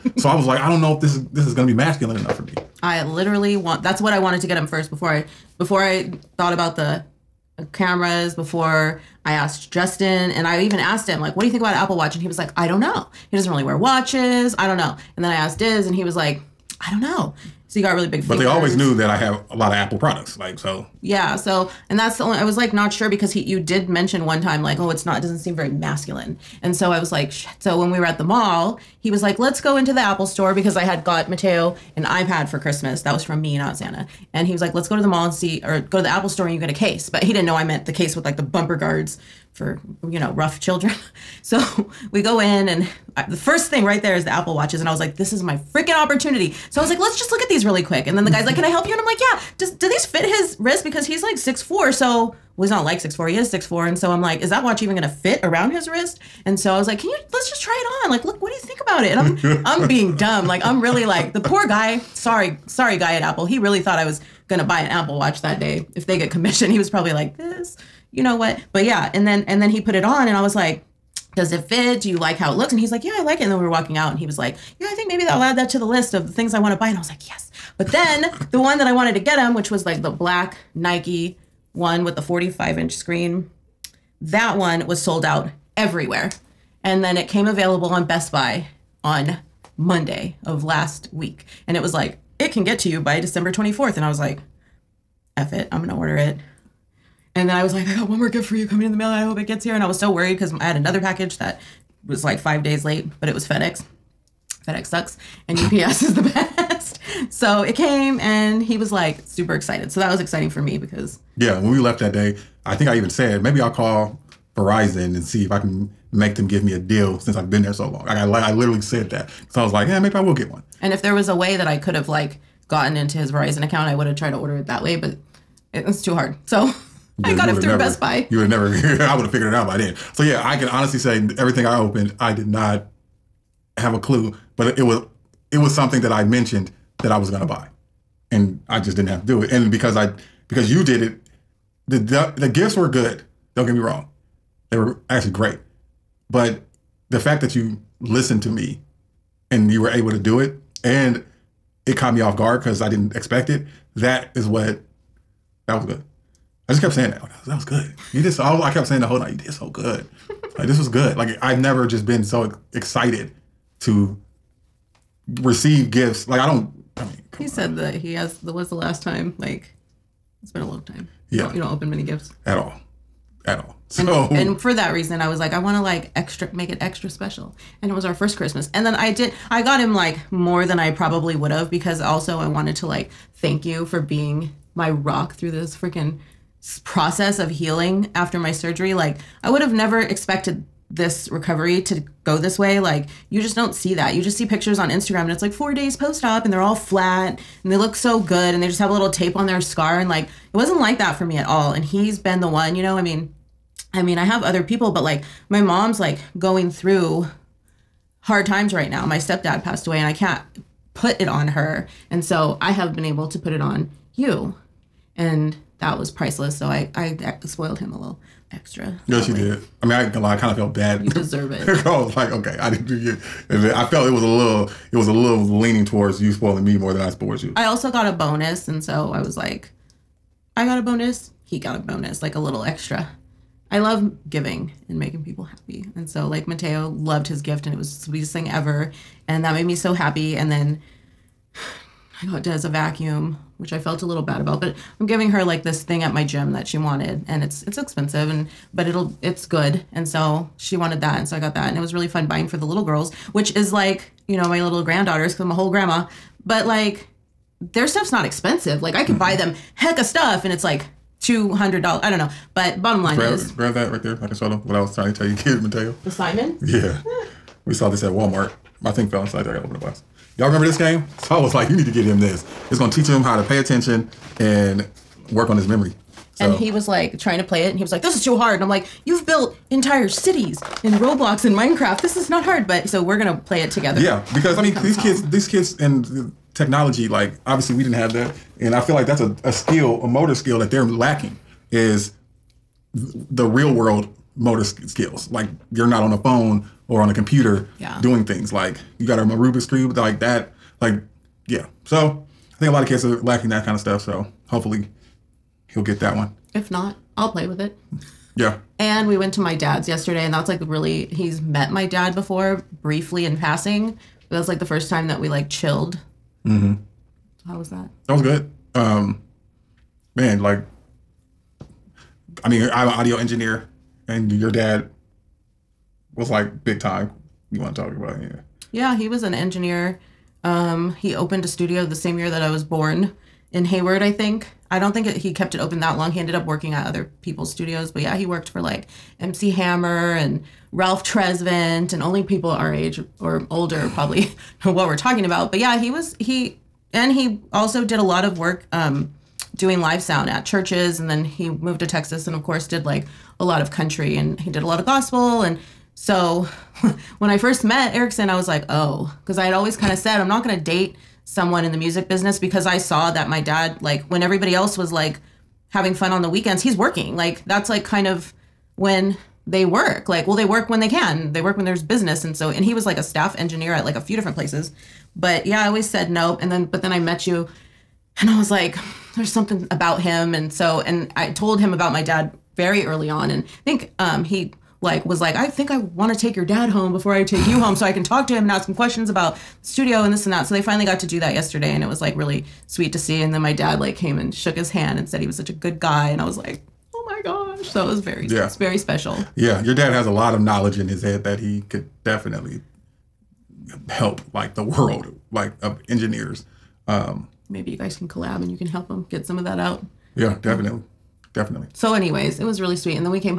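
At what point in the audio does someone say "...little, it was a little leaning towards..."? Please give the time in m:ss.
3:44.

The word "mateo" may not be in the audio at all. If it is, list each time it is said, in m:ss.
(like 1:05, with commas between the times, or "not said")
0:31, 3:56, 4:25.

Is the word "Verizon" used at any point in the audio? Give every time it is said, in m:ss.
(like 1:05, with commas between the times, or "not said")
1:54, 2:03.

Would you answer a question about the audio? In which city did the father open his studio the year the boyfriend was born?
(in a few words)
Hayward.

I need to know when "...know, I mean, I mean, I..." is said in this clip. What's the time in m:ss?
3:22.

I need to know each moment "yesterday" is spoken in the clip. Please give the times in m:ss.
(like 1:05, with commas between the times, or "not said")
5:09, 6:31.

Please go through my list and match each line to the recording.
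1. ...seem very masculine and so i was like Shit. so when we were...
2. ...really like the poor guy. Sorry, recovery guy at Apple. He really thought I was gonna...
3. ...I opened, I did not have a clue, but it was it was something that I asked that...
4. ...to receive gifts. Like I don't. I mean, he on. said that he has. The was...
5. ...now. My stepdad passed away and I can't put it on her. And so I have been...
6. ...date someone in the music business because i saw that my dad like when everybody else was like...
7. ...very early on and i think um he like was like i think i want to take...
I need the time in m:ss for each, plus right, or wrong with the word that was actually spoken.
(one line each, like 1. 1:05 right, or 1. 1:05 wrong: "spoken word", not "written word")
1. 0:25 right
2. 1:00 wrong: "sorry", not "recovery"
3. 2:11 wrong: "mentioned", not "asked"
4. 2:43 right
5. 3:28 right
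6. 6:00 right
7. 6:22 right.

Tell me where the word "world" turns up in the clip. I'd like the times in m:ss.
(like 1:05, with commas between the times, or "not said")
4:53, 6:44.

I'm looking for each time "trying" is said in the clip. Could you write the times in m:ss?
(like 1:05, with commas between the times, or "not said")
4:24, 4:37.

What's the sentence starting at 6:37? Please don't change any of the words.
So it was very yeah, it's very special.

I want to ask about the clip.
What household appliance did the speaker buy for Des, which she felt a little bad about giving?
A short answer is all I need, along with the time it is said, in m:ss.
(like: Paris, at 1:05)
A vacuum, at 4:02.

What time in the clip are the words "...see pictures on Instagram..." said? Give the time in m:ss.
3:14.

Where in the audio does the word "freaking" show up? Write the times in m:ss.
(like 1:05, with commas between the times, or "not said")
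0:45, 3:05.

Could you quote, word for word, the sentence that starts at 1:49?
So that was exciting for me because.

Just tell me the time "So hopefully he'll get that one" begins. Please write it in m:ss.
5:04.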